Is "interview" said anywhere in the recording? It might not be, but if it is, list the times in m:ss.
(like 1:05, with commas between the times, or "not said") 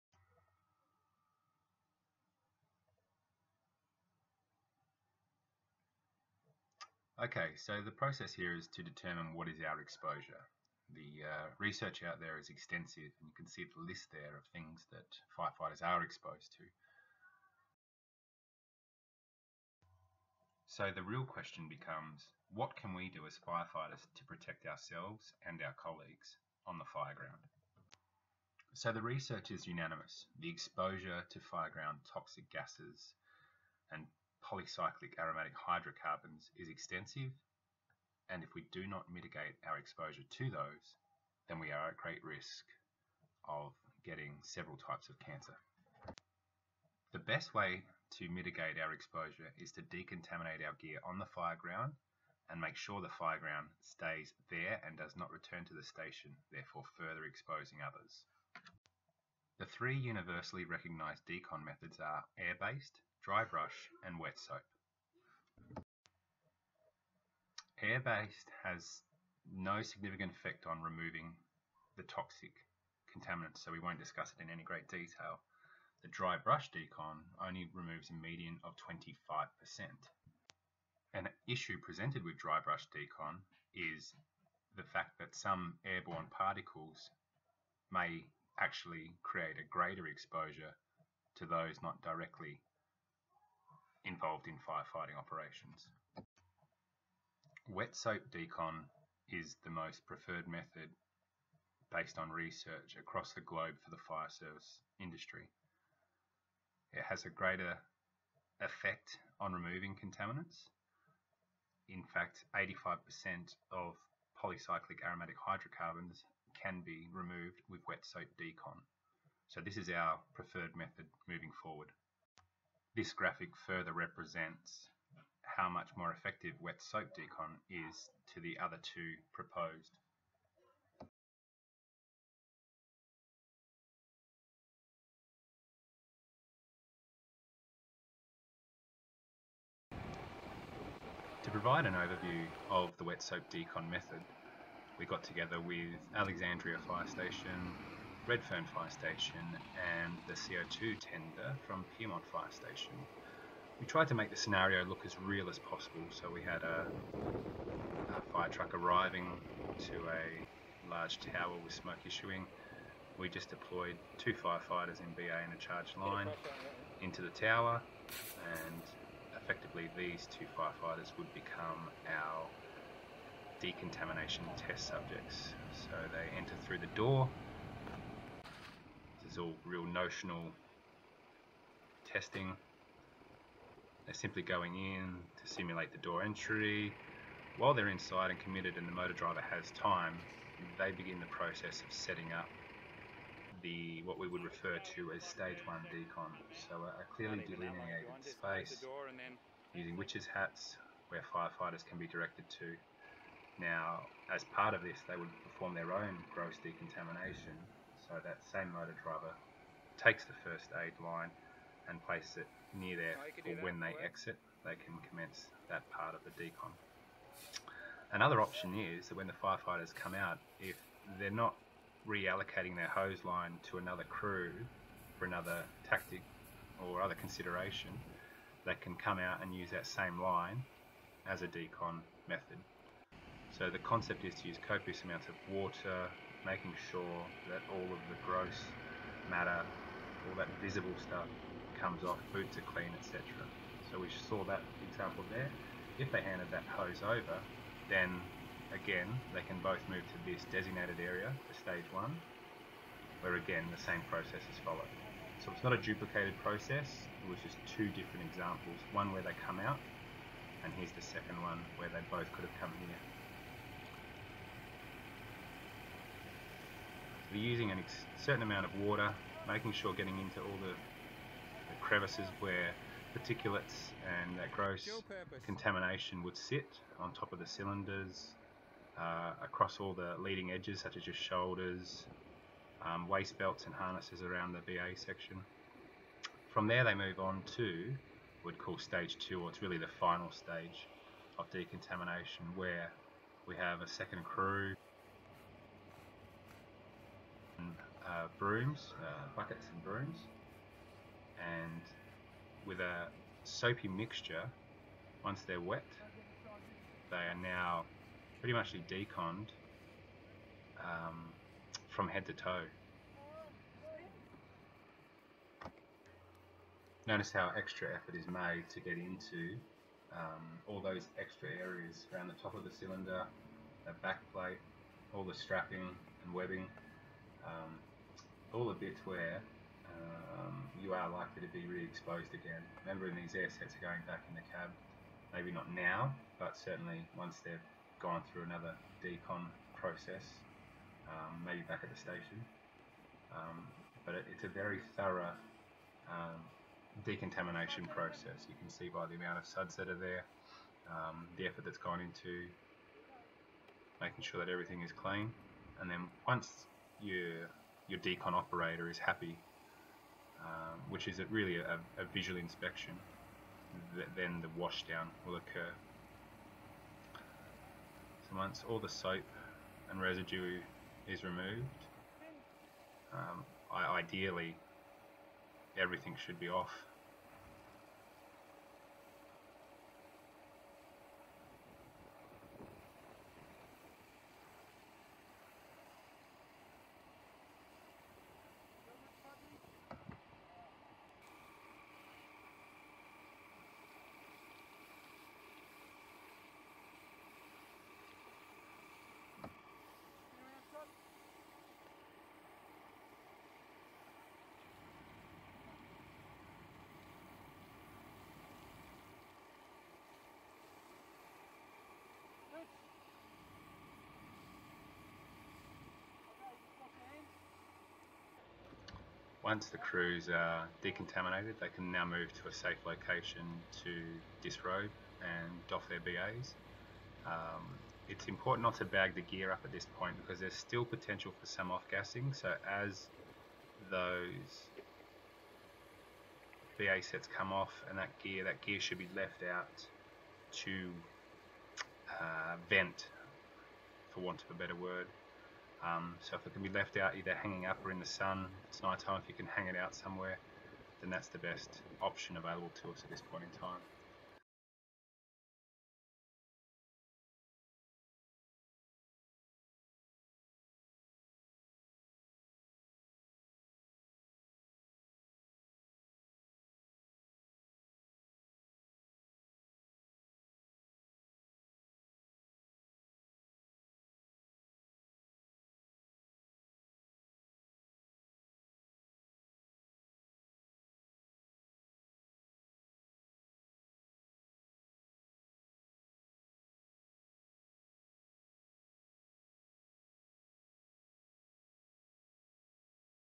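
not said.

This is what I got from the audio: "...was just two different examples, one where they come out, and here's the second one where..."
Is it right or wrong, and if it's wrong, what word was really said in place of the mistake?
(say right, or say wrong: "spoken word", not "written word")
right.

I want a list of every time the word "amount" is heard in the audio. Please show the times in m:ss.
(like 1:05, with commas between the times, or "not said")
3:55, 4:28, 5:49.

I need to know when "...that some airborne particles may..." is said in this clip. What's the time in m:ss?
1:25.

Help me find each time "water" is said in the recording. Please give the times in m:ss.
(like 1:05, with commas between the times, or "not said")
3:55, 4:28.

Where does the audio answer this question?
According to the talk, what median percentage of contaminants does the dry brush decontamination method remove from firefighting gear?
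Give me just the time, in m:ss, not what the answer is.
1:18.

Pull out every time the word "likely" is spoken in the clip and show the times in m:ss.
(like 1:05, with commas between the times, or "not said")
5:31.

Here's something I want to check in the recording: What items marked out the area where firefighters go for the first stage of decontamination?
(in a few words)
Witches' hats.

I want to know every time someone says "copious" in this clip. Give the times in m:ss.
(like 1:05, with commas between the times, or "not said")
3:54.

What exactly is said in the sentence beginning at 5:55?
And then once your your decon operator is happy, um, which is a, really a, a, visual inspection.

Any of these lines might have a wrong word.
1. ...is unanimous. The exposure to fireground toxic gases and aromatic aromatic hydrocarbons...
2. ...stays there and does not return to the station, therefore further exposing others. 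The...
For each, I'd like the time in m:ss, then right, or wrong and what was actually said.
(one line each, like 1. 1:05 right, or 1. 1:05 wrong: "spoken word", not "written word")
1. 0:29 wrong: "polycyclic", not "aromatic"
2. 0:53 right.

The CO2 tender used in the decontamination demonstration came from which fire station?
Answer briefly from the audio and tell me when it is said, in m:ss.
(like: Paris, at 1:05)
Pyrmont Fire Station, at 2:31.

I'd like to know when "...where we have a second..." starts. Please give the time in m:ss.
4:52.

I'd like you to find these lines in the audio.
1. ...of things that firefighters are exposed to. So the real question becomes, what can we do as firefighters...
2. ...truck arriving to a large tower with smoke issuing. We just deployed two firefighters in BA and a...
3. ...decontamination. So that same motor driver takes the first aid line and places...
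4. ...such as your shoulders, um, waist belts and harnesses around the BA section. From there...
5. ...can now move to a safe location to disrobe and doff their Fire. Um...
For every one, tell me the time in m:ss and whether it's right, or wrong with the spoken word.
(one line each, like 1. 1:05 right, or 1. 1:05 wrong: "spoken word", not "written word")
1. 0:14 right
2. 2:38 right
3. 3:26 right
4. 4:40 right
5. 7:01 wrong: "BAs", not "Fire".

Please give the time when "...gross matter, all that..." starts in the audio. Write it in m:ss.
3:58.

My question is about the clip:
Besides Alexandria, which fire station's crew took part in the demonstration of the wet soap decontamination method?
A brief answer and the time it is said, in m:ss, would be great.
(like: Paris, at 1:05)
Redfern Fire Station, at 2:28.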